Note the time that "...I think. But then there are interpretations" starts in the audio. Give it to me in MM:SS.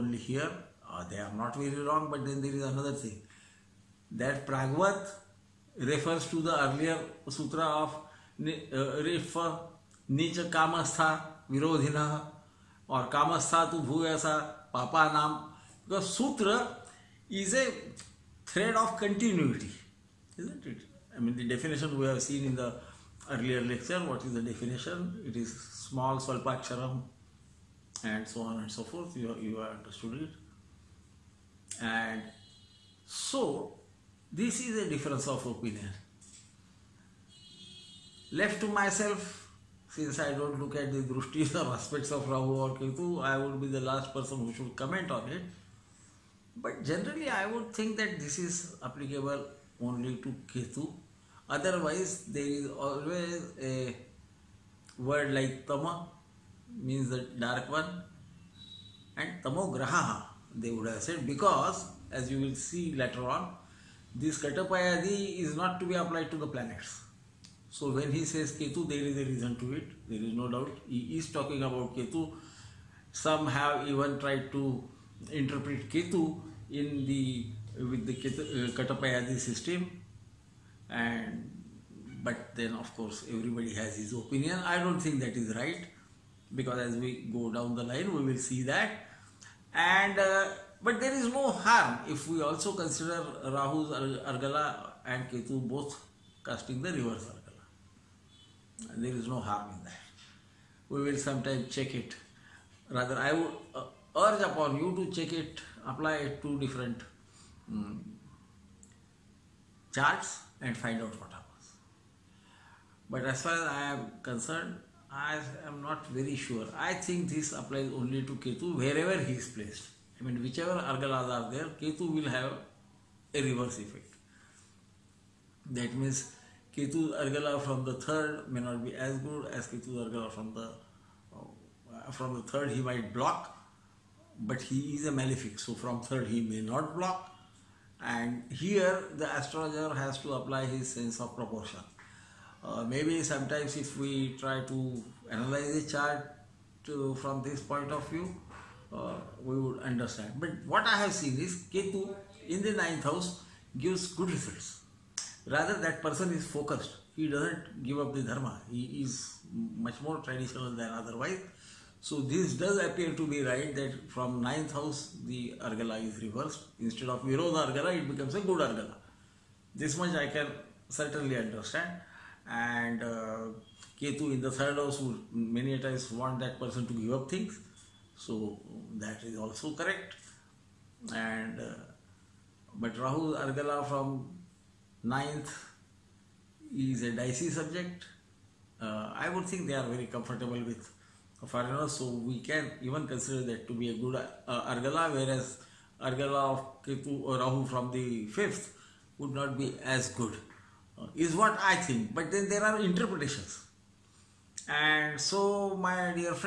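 03:21.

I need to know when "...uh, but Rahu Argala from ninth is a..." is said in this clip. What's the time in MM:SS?
03:01.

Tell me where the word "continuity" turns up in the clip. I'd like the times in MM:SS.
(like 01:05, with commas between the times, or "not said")
00:18.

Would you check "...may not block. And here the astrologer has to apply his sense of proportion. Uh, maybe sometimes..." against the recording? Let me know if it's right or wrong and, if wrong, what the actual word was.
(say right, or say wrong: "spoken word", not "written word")
right.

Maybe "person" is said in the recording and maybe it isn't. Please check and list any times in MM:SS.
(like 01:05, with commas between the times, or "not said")
00:44, 02:36, 02:56.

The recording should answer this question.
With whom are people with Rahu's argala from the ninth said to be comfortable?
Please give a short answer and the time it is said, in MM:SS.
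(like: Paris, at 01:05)
foreigners, at 03:11.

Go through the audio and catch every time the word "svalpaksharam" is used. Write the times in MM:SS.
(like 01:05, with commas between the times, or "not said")
00:26.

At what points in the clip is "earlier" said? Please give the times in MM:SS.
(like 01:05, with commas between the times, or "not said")
00:06, 00:23.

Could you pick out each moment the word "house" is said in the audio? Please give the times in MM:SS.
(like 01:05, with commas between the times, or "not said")
02:33, 02:44, 02:54.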